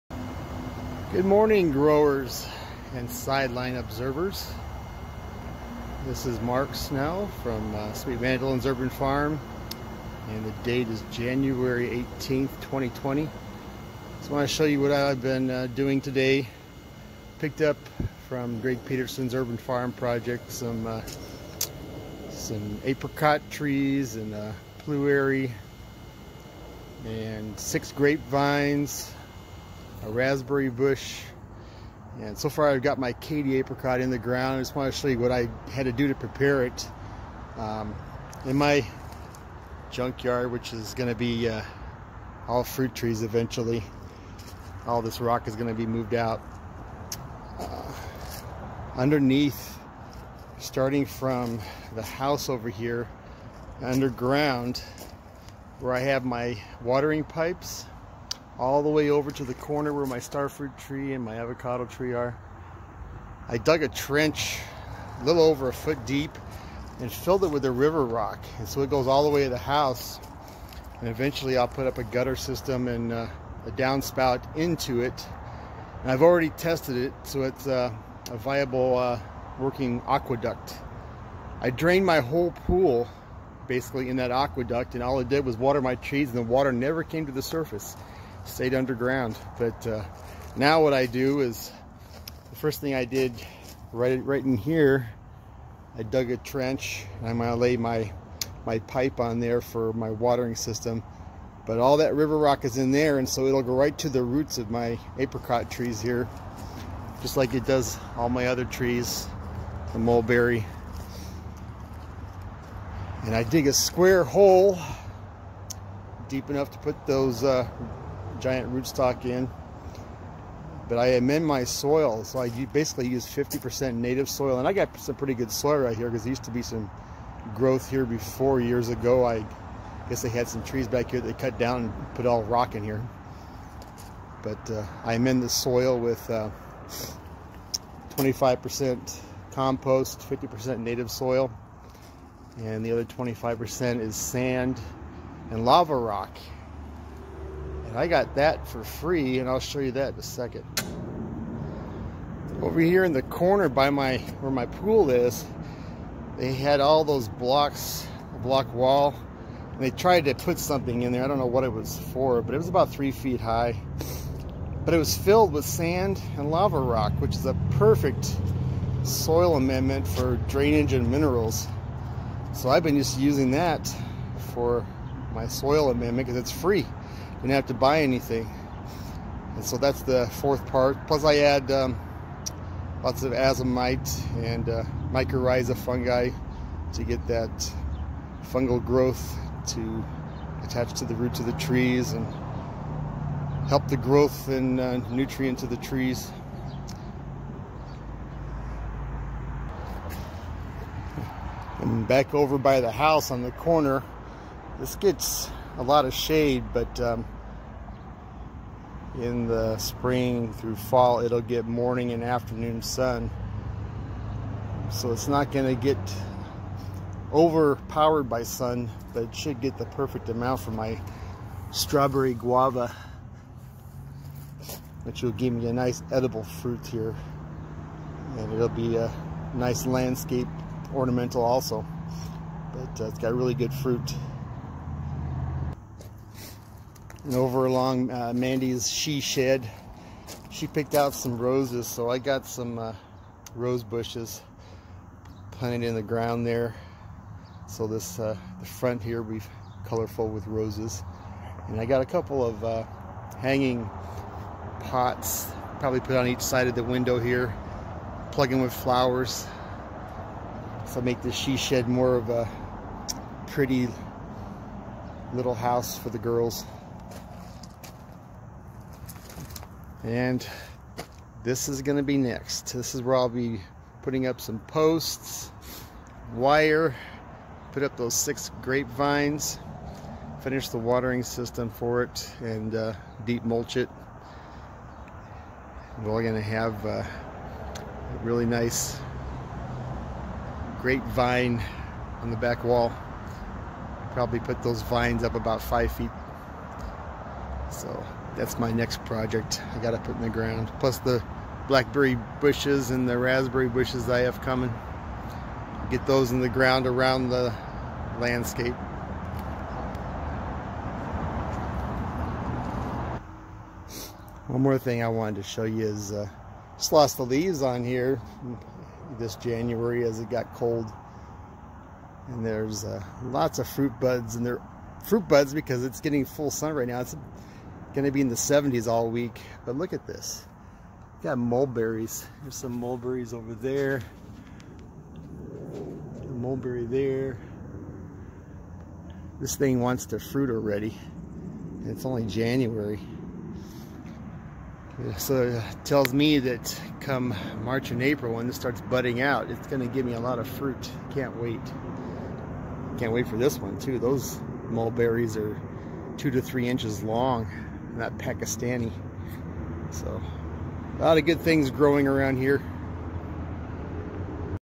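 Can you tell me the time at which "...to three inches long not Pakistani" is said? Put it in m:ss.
5:56.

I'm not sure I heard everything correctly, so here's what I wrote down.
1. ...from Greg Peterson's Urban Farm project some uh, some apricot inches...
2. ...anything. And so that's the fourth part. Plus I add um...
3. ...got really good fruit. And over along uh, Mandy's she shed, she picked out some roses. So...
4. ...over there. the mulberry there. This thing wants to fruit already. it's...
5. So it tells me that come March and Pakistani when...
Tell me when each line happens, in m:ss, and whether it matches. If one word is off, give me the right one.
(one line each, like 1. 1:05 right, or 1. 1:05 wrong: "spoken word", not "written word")
1. 0:18 wrong: "trees", not "inches"
2. 2:58 right
3. 3:53 right
4. 5:33 right
5. 5:45 wrong: "April", not "Pakistani".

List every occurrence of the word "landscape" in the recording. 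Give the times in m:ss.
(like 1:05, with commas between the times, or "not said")
3:49, 5:08.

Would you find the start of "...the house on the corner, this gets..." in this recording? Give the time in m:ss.
3:22.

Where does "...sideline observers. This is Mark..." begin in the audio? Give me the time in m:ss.
0:03.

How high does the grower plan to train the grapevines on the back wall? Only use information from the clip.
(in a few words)
5 feet.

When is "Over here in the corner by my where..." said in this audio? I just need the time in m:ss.
2:32.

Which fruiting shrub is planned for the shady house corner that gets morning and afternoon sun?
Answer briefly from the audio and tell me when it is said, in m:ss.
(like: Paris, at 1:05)
strawberry guava, at 3:41.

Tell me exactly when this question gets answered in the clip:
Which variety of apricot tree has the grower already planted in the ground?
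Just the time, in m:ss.
0:33.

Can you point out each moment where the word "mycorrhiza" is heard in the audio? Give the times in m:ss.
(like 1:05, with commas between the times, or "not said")
3:05.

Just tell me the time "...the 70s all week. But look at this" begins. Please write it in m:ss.
5:28.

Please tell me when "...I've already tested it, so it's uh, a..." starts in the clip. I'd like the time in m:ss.
1:16.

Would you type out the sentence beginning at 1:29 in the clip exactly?
But uh, now what I do is the first thing I did right right in here, I dug a trench.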